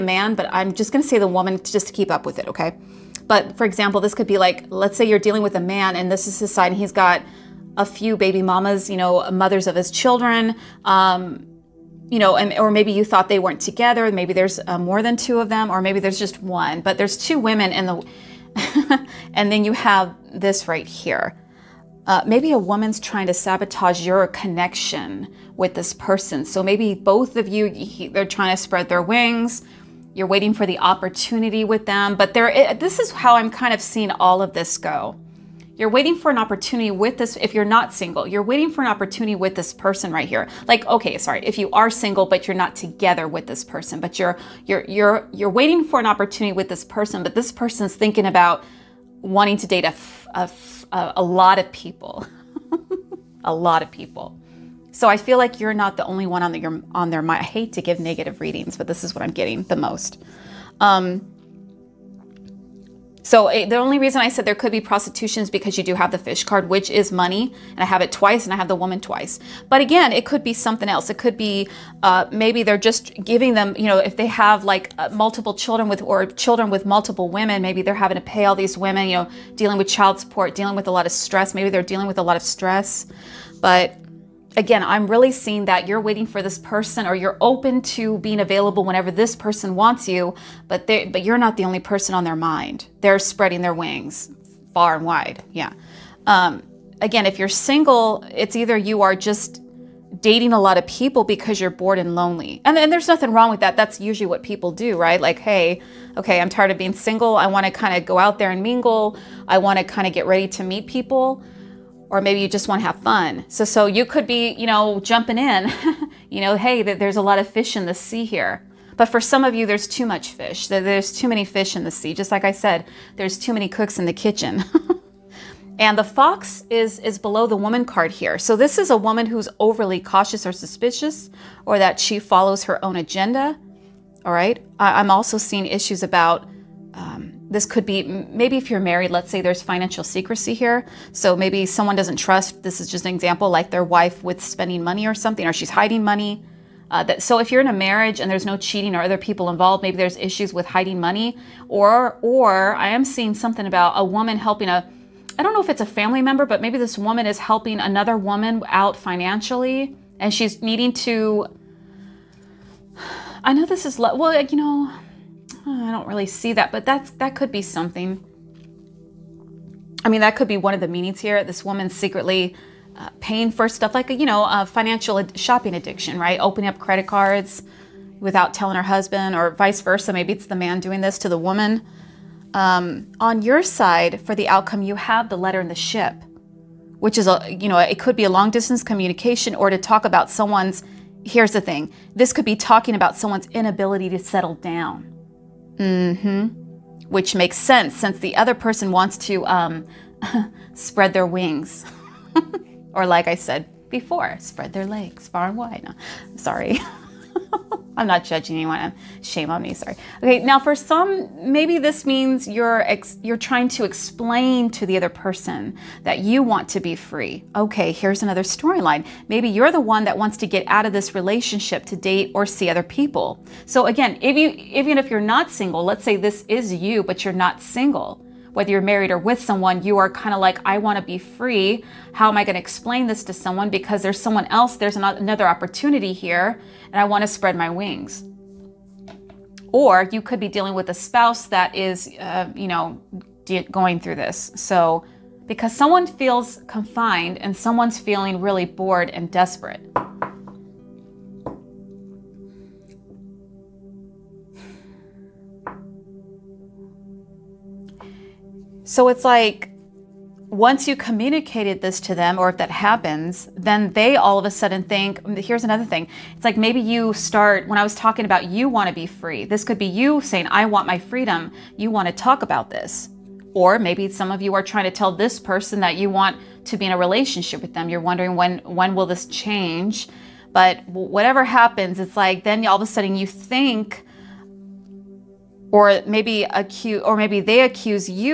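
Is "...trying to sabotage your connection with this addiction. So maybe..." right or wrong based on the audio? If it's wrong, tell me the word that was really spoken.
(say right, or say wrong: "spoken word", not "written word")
wrong: "person", not "addiction".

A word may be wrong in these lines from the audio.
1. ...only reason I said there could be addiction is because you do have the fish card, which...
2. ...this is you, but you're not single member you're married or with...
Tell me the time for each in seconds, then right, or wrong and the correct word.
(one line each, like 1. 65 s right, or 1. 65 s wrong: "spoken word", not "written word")
1. 63 s wrong: "prostitution", not "addiction"
2. 226 s wrong: "whether", not "member".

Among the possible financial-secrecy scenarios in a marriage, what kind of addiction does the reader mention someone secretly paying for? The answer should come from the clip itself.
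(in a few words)
Shopping addiction.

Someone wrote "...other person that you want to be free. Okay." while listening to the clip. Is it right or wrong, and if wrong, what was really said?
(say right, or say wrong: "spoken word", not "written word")
right.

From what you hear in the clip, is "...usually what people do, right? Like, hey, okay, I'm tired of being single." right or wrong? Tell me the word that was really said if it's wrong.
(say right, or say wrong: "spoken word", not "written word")
right.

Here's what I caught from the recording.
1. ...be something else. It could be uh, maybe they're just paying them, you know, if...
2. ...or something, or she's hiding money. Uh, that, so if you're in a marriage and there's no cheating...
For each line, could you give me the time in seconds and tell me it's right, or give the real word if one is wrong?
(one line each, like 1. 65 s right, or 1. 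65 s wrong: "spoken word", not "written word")
1. 70 s wrong: "giving", not "paying"
2. 145 s right.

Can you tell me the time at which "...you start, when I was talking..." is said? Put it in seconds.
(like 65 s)
266 s.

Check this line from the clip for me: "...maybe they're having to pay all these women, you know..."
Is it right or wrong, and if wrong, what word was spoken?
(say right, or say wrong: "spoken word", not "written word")
right.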